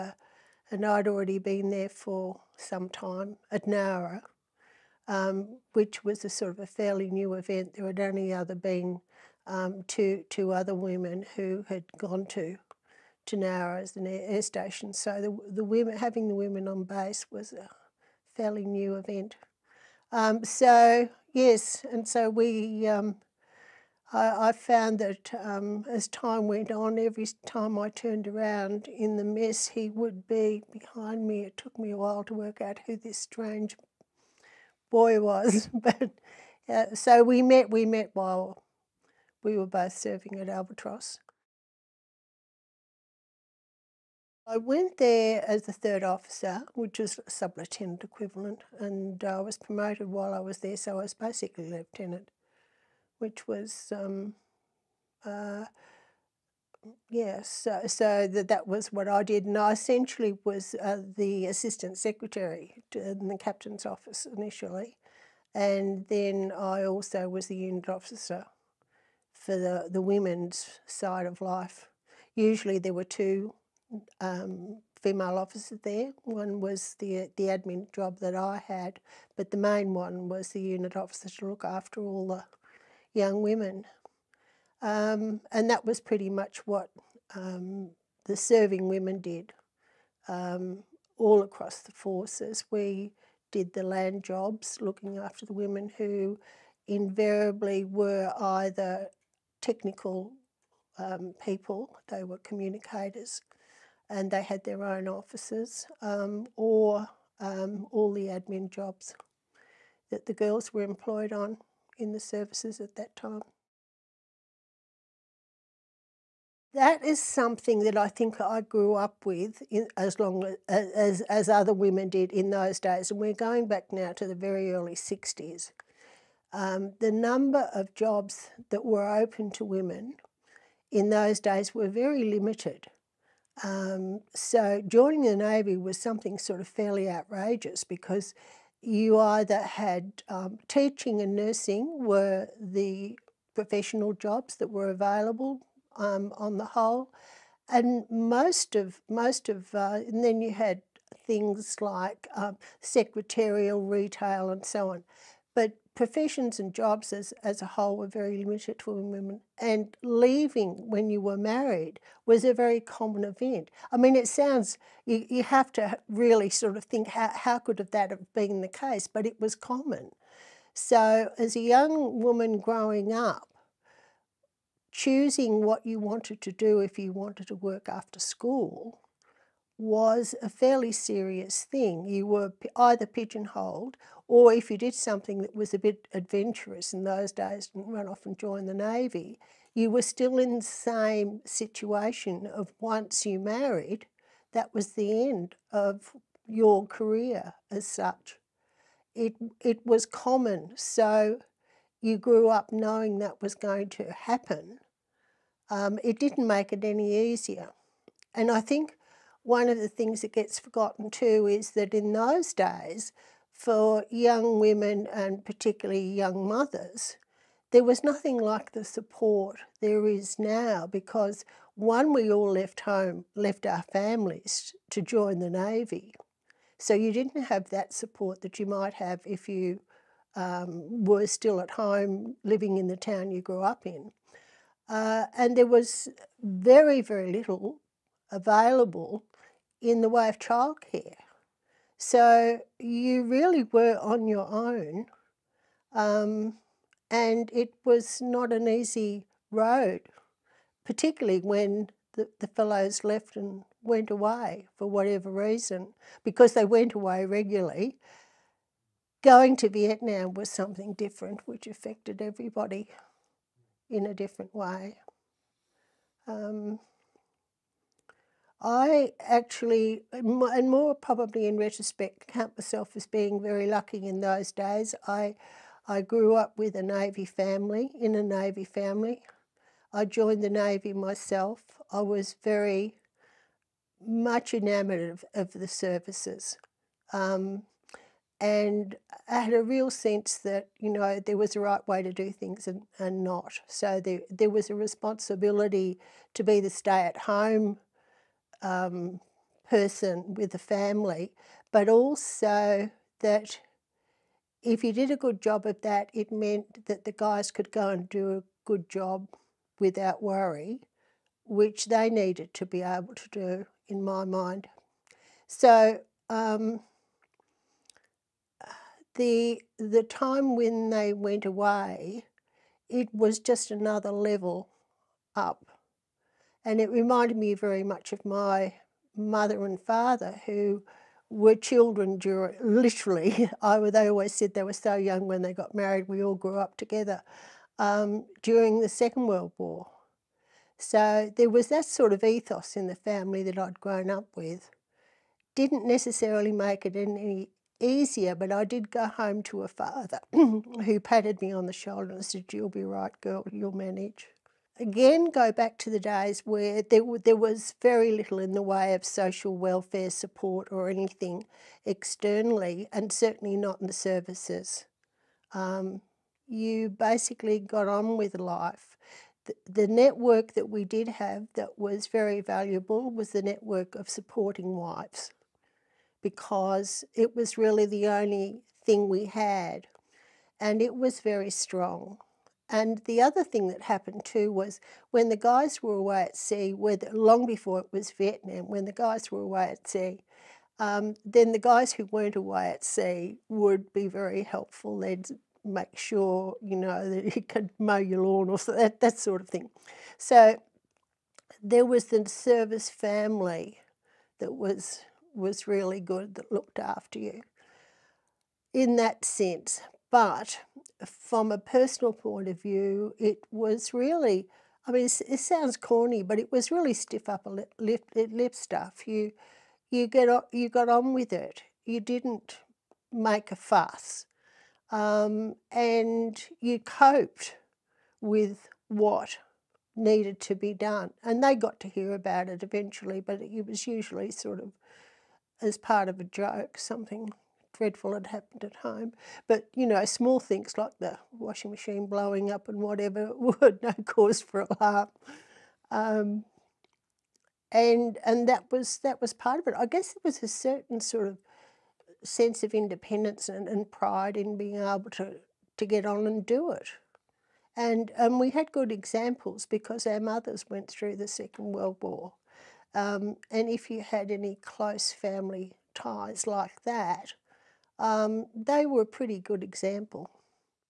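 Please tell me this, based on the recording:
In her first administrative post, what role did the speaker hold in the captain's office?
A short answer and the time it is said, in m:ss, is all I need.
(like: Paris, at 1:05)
Assistant secretary, at 1:01.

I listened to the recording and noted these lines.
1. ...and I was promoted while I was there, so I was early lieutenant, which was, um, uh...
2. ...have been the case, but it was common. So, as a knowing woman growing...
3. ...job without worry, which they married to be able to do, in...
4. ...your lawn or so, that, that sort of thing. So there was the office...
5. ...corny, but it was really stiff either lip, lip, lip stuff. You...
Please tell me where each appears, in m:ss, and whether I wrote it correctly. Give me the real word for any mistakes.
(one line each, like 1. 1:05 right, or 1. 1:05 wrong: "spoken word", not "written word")
1. 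0:48 wrong: "basically", not "early"
2. 2:48 wrong: "young", not "knowing"
3. 5:08 wrong: "needed", not "married"
4. 6:37 wrong: "service", not "office"
5. 6:55 wrong: "upper", not "either".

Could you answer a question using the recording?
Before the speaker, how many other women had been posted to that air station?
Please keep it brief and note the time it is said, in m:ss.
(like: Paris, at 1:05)
2, at 0:09.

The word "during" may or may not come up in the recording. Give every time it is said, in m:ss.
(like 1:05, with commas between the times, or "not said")
5:32, 5:38.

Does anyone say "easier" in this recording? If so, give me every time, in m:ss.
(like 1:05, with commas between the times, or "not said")
3:27, 5:47.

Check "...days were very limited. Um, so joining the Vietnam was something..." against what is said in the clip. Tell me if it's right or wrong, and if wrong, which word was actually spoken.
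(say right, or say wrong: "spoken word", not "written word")
wrong: "Navy", not "Vietnam".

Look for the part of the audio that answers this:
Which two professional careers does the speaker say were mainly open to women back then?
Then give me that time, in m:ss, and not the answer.
2:20.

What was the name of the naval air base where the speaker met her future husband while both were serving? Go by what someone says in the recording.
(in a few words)
Albatross.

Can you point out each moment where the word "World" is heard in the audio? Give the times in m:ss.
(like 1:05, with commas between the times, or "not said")
5:39, 7:41.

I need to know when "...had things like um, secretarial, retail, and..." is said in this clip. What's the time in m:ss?
2:30.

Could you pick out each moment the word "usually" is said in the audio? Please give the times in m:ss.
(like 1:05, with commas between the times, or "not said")
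1:12, 7:13.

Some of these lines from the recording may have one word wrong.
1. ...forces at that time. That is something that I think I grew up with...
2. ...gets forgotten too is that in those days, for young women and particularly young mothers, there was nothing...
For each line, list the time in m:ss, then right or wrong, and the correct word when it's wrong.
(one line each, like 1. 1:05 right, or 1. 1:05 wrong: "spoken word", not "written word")
1. 1:52 wrong: "services", not "forces"
2. 3:30 right.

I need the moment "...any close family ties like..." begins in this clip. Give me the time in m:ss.
7:44.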